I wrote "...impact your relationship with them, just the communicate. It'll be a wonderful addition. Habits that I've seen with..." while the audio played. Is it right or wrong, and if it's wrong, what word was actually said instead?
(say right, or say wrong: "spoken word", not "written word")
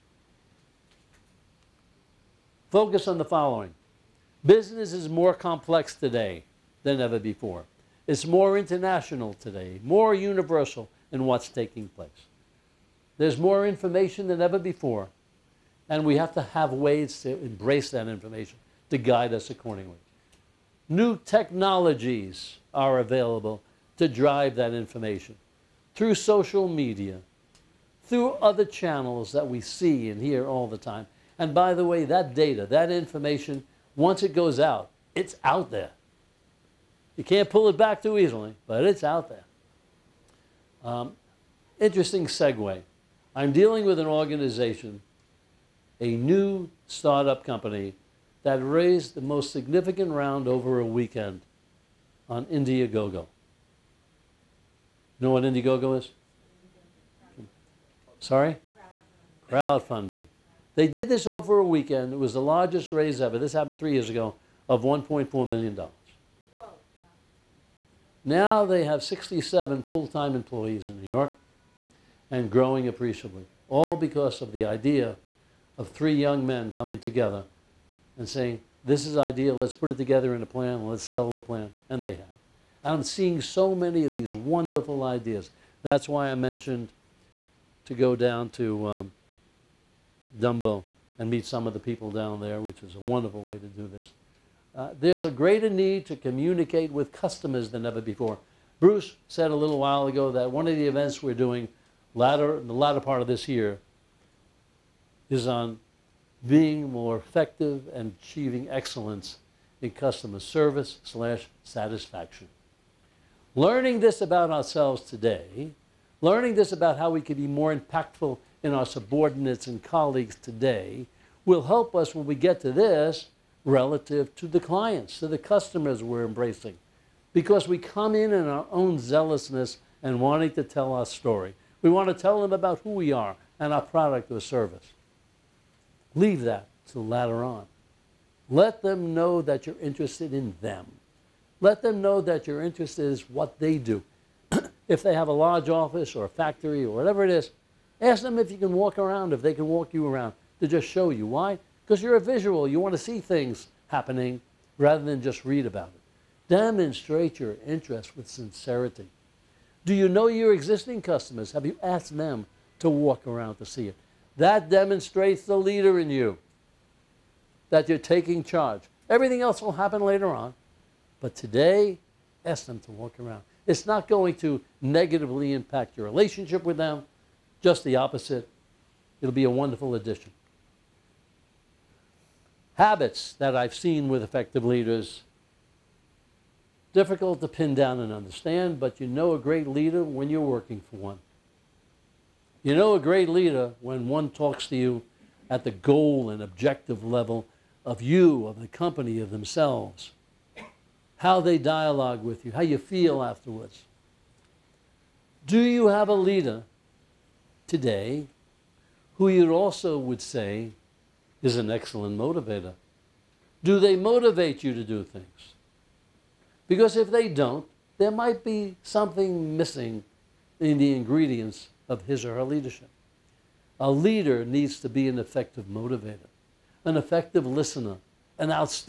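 wrong: "opposite", not "communicate".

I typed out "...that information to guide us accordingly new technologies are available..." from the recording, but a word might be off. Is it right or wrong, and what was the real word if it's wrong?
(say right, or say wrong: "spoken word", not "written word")
right.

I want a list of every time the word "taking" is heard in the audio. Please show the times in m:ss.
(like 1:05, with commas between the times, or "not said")
0:11, 2:47.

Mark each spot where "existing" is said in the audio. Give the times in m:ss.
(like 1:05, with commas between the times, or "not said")
2:40.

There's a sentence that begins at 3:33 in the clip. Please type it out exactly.
Do they motivate you to do things?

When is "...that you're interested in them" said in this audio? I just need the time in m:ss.
2:19.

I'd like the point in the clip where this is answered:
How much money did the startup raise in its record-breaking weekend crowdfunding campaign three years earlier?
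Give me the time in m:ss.
1:04.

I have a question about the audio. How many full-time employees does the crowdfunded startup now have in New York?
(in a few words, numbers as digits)
67.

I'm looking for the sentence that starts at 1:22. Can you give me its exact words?
I'm seeing so many of these wonderful ideas.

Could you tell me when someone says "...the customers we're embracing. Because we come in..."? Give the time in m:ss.
2:05.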